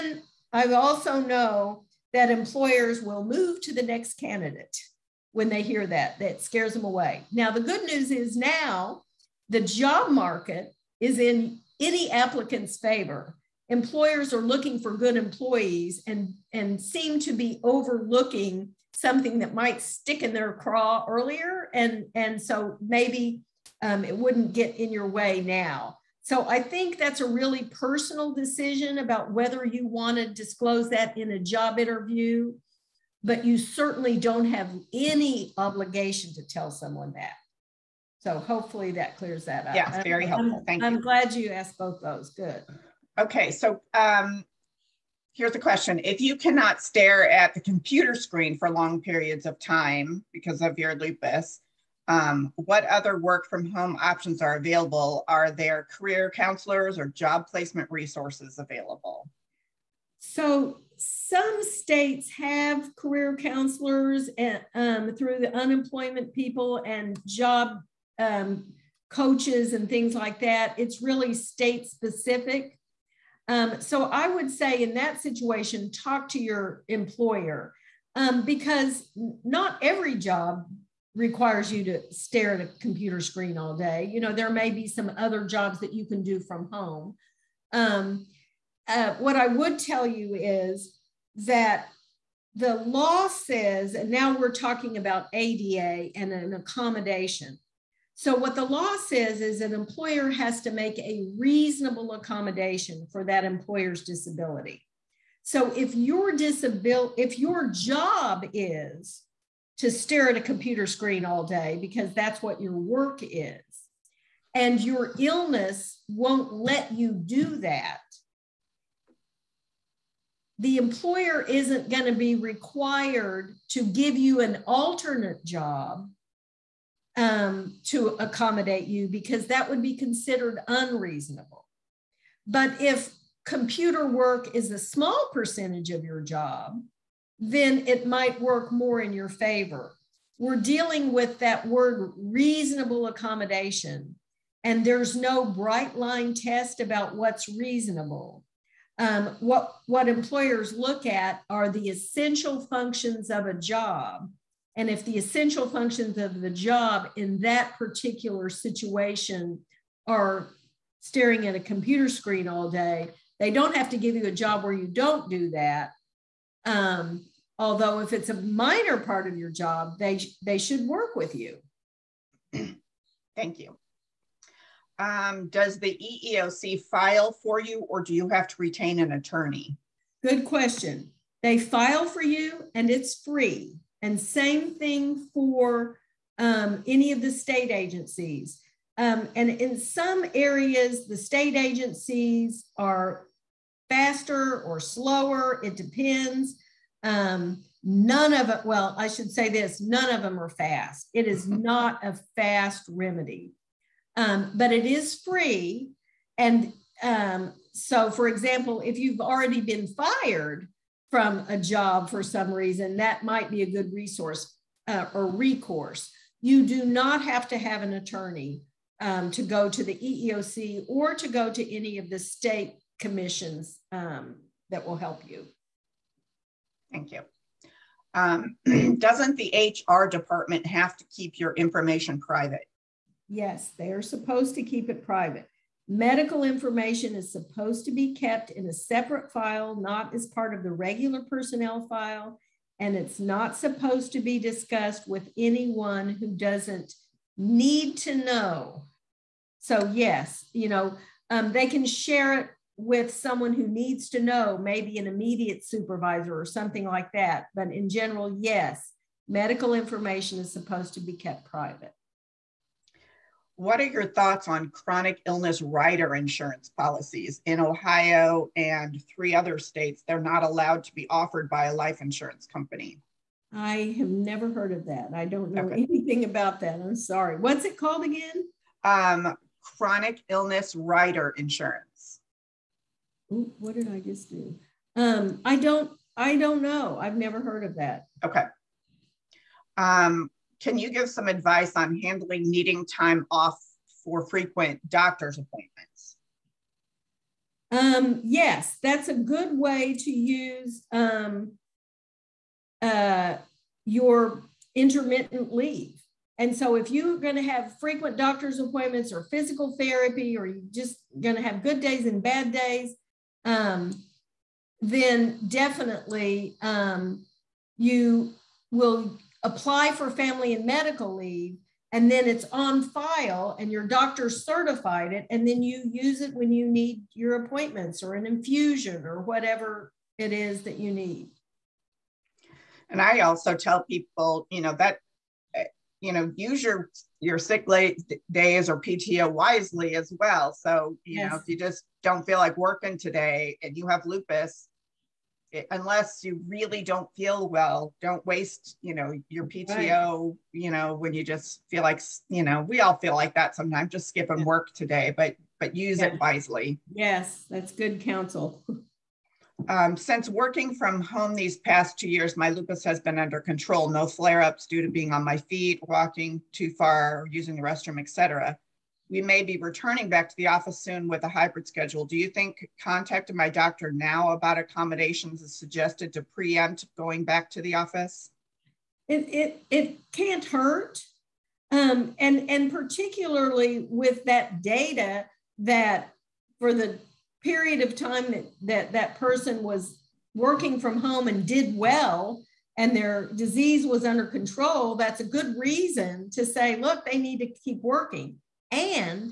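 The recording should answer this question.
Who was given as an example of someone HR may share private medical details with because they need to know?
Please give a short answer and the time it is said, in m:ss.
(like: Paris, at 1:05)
immediate supervisor, at 4:15.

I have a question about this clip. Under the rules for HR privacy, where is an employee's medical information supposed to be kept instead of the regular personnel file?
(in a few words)
a separate file.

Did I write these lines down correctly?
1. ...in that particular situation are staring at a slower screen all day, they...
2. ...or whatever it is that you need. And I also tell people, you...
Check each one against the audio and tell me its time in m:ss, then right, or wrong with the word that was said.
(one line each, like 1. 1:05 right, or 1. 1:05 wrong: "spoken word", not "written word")
1. 2:37 wrong: "computer", not "slower"
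2. 5:29 right.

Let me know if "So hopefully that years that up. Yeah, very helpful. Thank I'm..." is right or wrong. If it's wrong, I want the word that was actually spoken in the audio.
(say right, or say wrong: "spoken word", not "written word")
wrong: "clears", not "years".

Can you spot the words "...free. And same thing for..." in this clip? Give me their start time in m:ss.
3:03.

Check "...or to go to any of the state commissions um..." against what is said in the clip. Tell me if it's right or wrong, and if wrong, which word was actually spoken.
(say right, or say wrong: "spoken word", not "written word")
right.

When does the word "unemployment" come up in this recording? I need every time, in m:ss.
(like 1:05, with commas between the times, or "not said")
1:05.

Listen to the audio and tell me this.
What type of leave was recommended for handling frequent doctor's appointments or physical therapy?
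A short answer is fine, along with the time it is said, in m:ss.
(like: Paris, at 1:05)
intermittent leave, at 5:04.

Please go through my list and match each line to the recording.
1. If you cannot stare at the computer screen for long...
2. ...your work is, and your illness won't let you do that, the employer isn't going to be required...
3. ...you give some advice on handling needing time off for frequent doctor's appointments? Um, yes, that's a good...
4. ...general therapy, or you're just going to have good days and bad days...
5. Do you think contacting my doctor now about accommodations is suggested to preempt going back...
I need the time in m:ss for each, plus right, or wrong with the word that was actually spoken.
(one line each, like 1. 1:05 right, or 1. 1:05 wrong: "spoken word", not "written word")
1. 0:46 right
2. 1:52 right
3. 4:50 right
4. 5:09 wrong: "physical", not "general"
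5. 6:12 right.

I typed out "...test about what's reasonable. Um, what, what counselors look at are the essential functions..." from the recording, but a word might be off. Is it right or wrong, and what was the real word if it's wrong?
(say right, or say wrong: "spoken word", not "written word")
wrong: "employers", not "counselors".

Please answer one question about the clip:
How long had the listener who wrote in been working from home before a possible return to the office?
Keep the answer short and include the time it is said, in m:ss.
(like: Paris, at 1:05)
2 years, at 6:01.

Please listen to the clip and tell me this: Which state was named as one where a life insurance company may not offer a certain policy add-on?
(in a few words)
Ohio.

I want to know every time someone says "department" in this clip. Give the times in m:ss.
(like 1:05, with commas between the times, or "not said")
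3:50.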